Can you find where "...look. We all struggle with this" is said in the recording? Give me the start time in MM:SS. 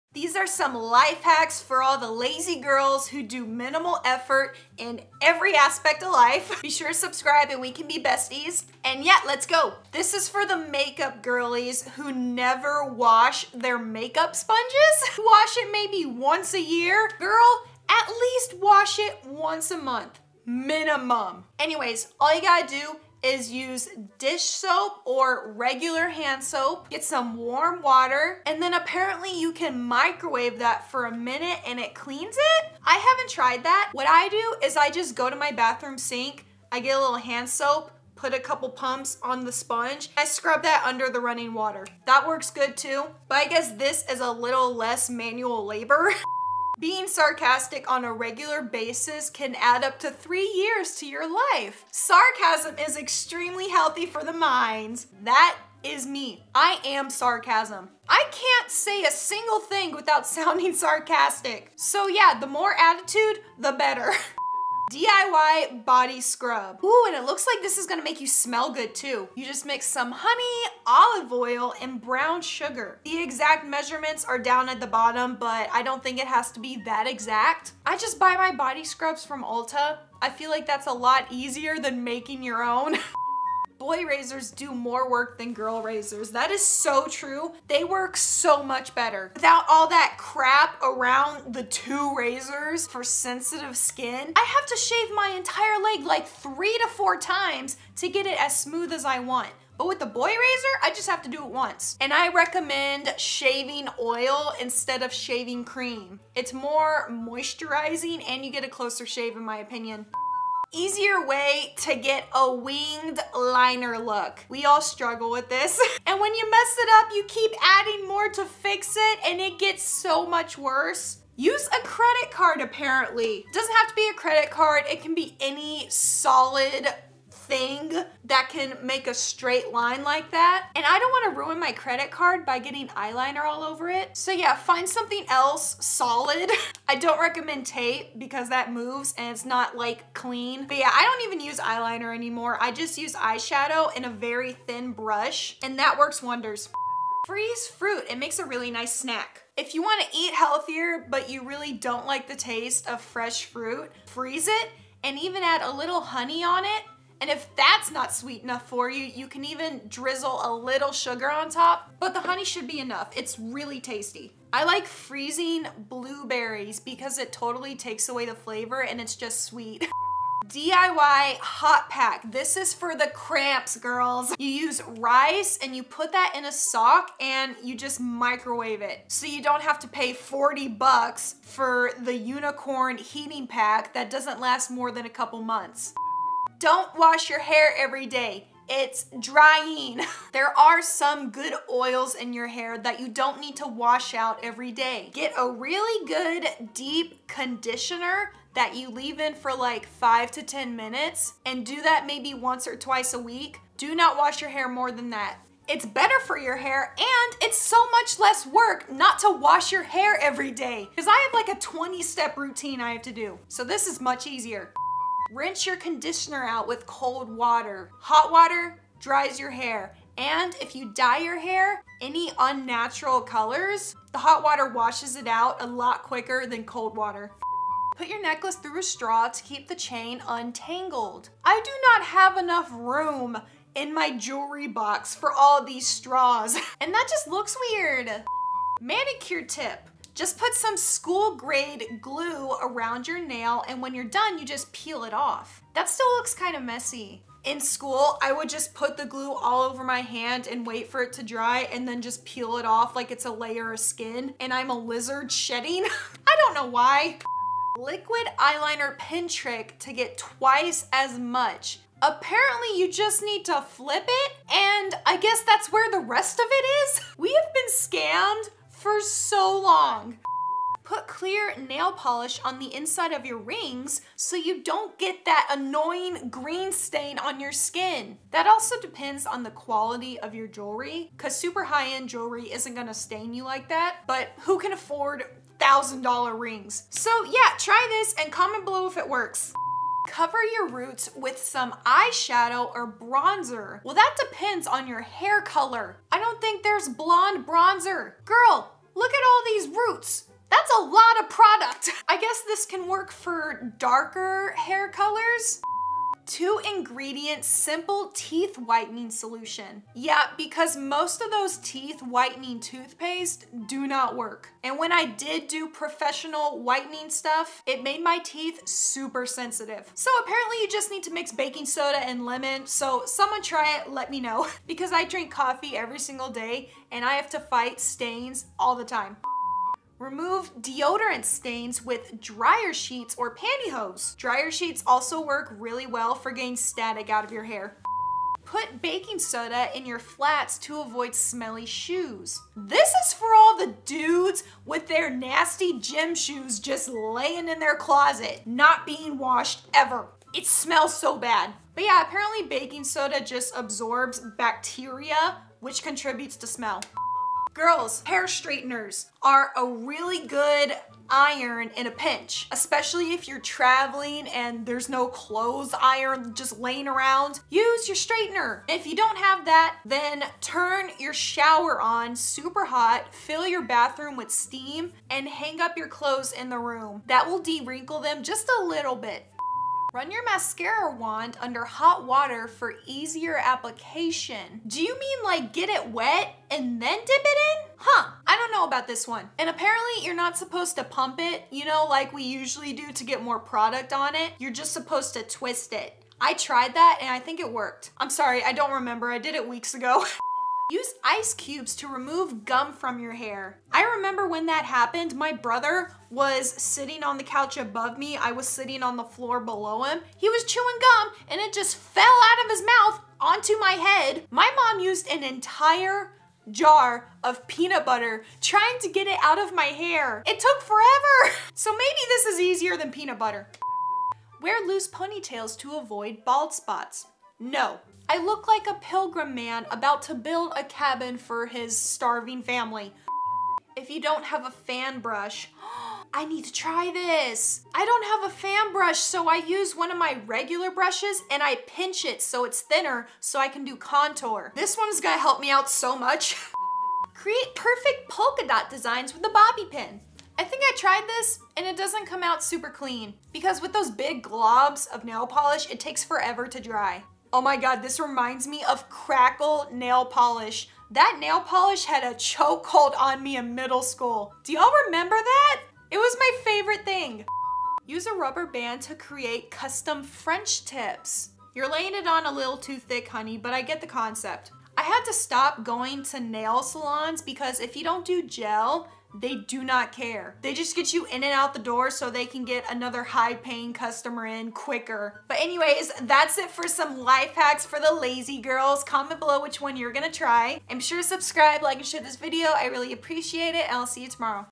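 01:53.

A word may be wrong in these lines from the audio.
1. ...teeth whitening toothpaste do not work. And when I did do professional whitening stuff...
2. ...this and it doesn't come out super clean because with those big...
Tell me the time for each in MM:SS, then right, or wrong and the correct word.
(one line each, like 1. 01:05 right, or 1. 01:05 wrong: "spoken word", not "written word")
1. 05:11 right
2. 07:31 right.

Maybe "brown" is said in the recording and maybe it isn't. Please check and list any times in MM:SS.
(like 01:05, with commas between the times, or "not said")
01:12.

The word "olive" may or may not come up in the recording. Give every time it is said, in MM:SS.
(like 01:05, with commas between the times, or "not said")
01:10.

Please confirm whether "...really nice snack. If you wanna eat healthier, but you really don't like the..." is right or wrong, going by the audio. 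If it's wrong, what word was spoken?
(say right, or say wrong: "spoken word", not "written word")
right.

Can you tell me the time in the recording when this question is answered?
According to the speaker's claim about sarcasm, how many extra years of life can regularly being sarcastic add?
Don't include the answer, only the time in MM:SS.
00:50.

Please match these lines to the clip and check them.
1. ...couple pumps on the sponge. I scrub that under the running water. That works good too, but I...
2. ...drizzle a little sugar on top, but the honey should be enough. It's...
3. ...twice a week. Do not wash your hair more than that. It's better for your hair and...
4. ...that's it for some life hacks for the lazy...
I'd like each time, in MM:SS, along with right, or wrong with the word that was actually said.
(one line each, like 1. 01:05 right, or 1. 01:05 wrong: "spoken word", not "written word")
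1. 00:38 right
2. 02:39 right
3. 03:22 right
4. 08:06 right.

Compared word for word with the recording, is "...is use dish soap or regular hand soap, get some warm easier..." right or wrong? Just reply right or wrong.
wrong.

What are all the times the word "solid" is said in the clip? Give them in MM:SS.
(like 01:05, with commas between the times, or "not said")
02:05, 02:15.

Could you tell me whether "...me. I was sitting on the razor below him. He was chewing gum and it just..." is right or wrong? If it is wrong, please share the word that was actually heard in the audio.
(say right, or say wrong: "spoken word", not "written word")
wrong: "floor", not "razor".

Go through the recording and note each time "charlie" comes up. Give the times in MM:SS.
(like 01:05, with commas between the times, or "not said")
not said.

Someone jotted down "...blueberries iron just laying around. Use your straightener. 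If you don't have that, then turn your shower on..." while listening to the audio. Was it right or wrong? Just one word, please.
wrong.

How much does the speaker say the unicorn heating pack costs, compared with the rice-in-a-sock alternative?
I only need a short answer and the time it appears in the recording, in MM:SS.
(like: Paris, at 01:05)
$40, at 03:00.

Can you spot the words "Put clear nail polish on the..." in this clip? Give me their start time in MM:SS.
04:30.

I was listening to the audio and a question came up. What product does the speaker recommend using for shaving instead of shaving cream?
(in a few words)
shaving oil.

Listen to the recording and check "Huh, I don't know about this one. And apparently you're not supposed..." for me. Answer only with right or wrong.
right.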